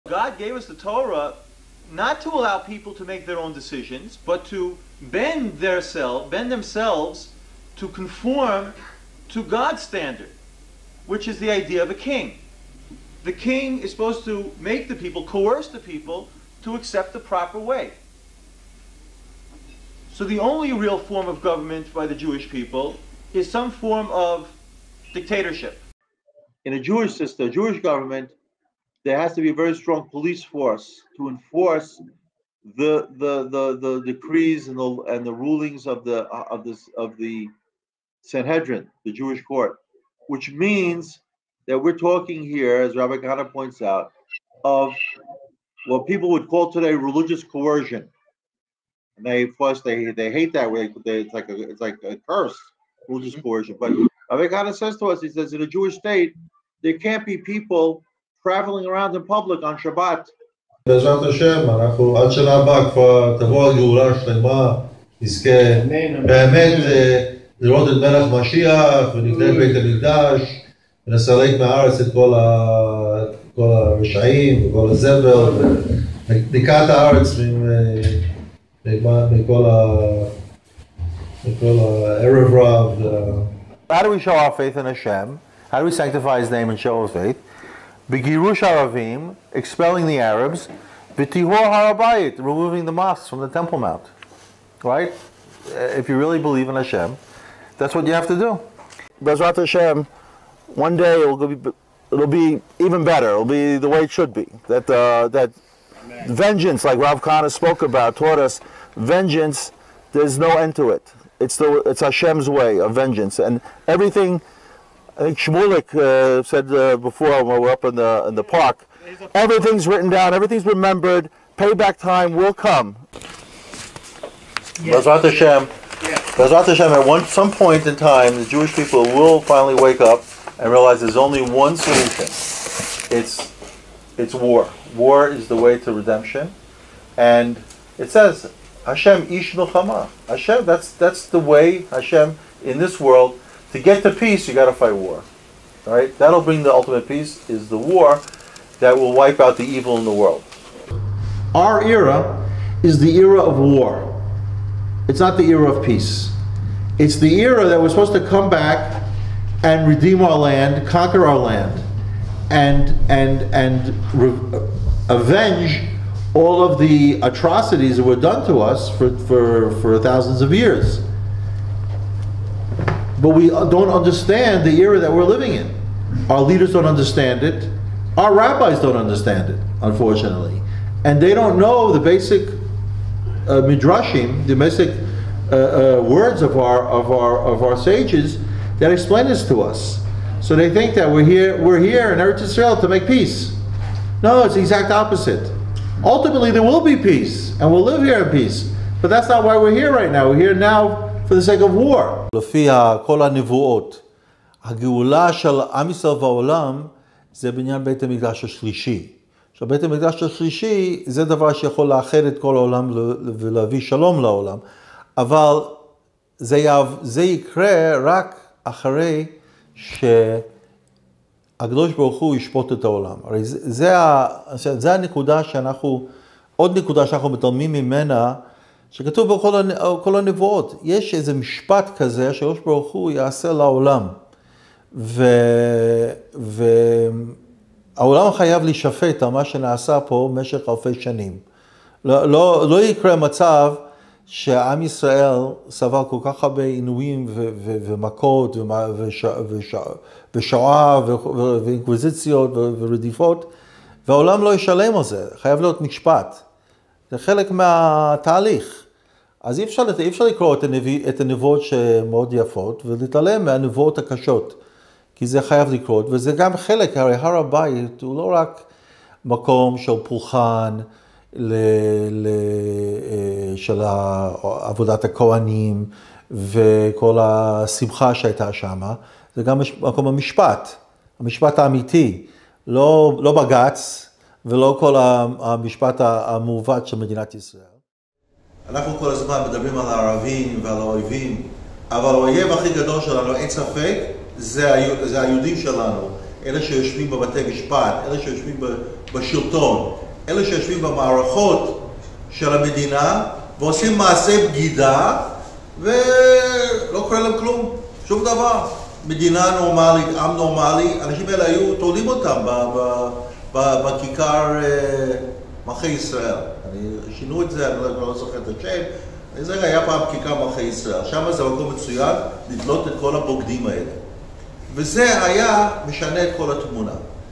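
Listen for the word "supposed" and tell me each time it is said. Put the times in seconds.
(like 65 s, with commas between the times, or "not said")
13 s, 157 s.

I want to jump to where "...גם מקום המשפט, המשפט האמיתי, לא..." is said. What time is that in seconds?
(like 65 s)
279 s.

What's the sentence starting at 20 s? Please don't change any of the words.
So the only real form of government by the Jewish people is some form of dictatorship.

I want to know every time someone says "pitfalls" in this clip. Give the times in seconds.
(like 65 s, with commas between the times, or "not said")
not said.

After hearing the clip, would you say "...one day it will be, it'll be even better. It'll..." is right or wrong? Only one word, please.
right.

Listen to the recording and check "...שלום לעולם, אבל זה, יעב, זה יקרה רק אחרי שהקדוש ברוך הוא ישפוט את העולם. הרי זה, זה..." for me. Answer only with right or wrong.
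right.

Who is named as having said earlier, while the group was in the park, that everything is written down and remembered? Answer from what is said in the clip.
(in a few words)
Shmulik.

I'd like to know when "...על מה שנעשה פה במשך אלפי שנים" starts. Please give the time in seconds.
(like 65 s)
239 s.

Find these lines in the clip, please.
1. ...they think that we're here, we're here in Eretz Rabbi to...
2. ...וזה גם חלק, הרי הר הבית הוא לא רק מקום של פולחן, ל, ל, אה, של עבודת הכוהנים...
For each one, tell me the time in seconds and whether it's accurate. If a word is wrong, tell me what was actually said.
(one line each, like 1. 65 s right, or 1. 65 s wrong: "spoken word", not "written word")
1. 190 s wrong: "Israel", not "Rabbi"
2. 266 s right.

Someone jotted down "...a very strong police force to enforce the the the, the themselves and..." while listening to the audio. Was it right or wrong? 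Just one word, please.
wrong.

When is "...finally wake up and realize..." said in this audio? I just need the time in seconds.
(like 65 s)
129 s.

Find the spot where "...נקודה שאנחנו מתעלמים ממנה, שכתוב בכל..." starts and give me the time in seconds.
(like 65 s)
226 s.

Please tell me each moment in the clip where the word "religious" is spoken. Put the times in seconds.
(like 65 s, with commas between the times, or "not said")
46 s, 53 s.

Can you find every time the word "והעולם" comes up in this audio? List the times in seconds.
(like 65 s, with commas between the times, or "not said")
206 s, 254 s.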